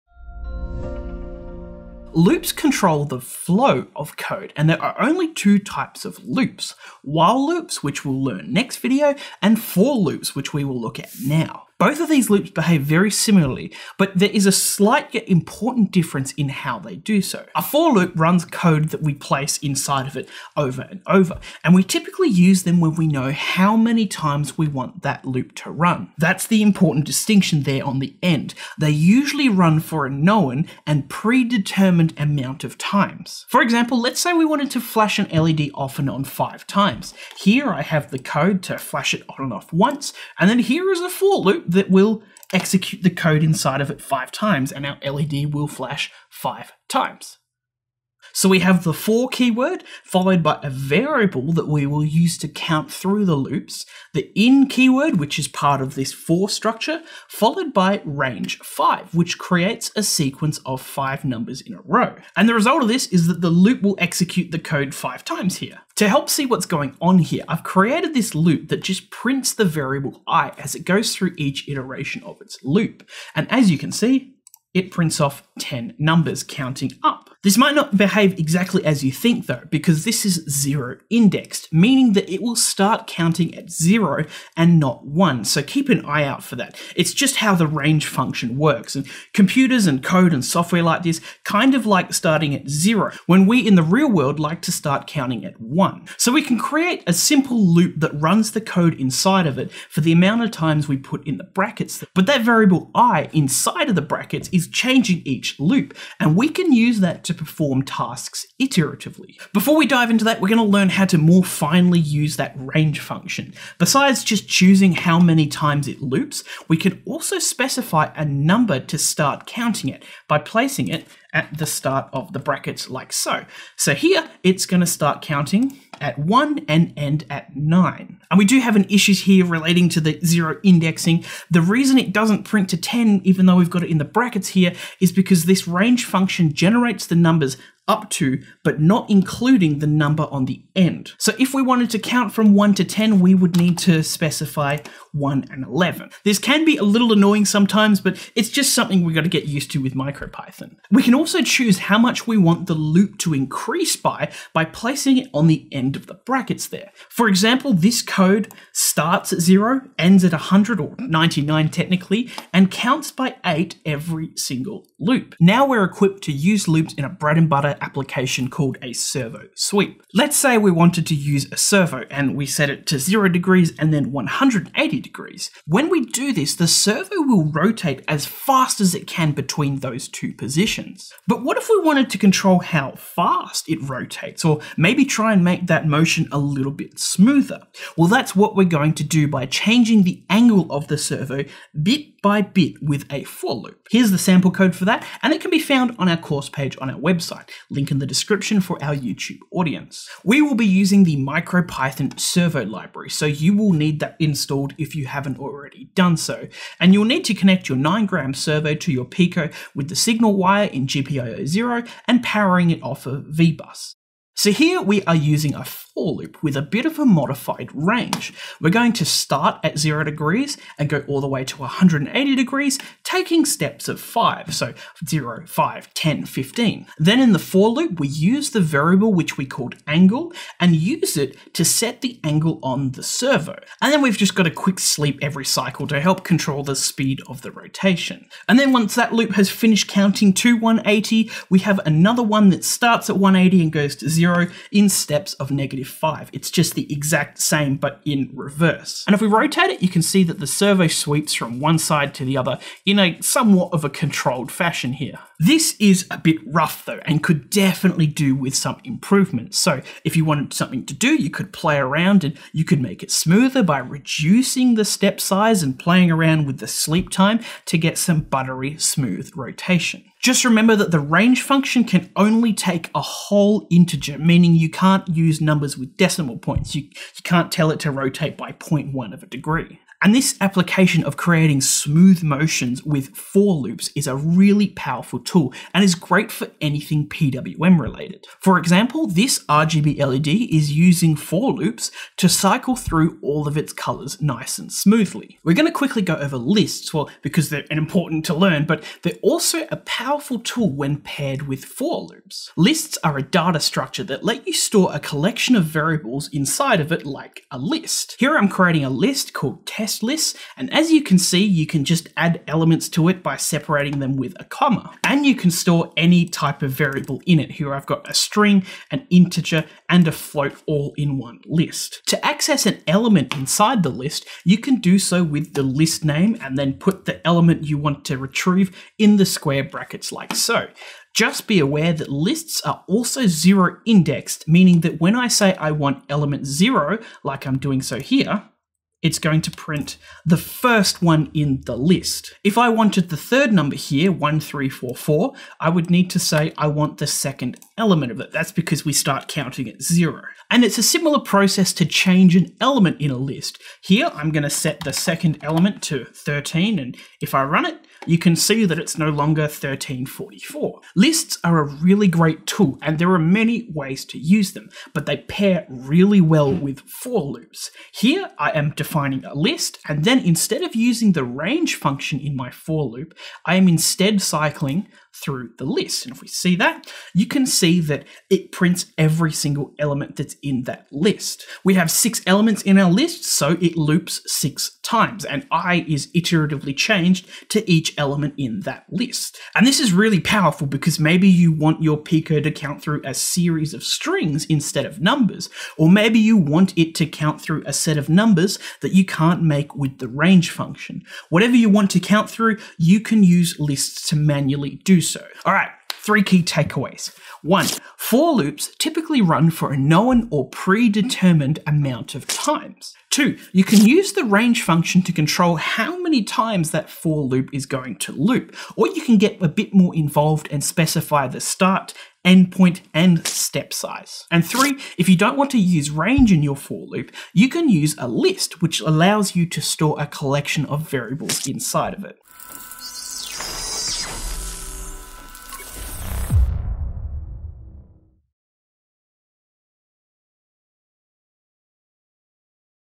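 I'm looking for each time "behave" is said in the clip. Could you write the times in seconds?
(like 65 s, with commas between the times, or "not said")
12 s, 77 s.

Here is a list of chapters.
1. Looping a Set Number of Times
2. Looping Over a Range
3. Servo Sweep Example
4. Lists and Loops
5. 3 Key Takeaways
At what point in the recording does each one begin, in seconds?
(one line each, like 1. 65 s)
1. 33 s
2. 113 s
3. 165 s
4. 295 s
5. 405 s.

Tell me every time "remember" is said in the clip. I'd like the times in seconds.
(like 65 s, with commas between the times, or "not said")
270 s.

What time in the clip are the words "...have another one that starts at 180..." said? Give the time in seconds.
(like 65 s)
241 s.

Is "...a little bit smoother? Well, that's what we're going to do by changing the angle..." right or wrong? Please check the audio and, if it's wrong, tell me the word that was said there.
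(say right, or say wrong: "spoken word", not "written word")
right.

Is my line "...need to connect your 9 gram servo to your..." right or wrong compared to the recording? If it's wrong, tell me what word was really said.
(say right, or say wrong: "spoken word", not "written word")
right.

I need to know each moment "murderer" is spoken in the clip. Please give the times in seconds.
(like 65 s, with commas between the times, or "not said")
not said.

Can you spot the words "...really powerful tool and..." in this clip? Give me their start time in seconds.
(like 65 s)
284 s.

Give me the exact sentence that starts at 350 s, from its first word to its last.
And it's a similar process to change an element in a list.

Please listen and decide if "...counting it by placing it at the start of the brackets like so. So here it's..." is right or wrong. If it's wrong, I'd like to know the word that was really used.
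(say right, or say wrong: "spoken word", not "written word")
right.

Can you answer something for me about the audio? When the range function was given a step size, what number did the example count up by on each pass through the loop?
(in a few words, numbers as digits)
8.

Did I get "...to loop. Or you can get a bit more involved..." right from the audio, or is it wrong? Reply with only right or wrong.
right.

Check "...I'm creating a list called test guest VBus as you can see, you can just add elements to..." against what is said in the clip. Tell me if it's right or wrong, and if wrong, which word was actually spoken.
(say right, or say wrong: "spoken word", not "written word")
wrong: "And", not "VBus".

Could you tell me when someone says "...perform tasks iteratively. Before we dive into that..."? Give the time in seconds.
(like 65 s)
107 s.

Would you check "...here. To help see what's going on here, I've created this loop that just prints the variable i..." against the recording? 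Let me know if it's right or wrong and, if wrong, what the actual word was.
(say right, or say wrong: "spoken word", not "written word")
right.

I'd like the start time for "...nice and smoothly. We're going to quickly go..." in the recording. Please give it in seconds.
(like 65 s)
294 s.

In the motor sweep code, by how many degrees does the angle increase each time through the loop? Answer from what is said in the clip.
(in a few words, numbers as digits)
5.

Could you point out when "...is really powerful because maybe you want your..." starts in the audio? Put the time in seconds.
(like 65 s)
389 s.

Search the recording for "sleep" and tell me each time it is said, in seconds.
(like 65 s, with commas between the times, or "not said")
234 s, 266 s.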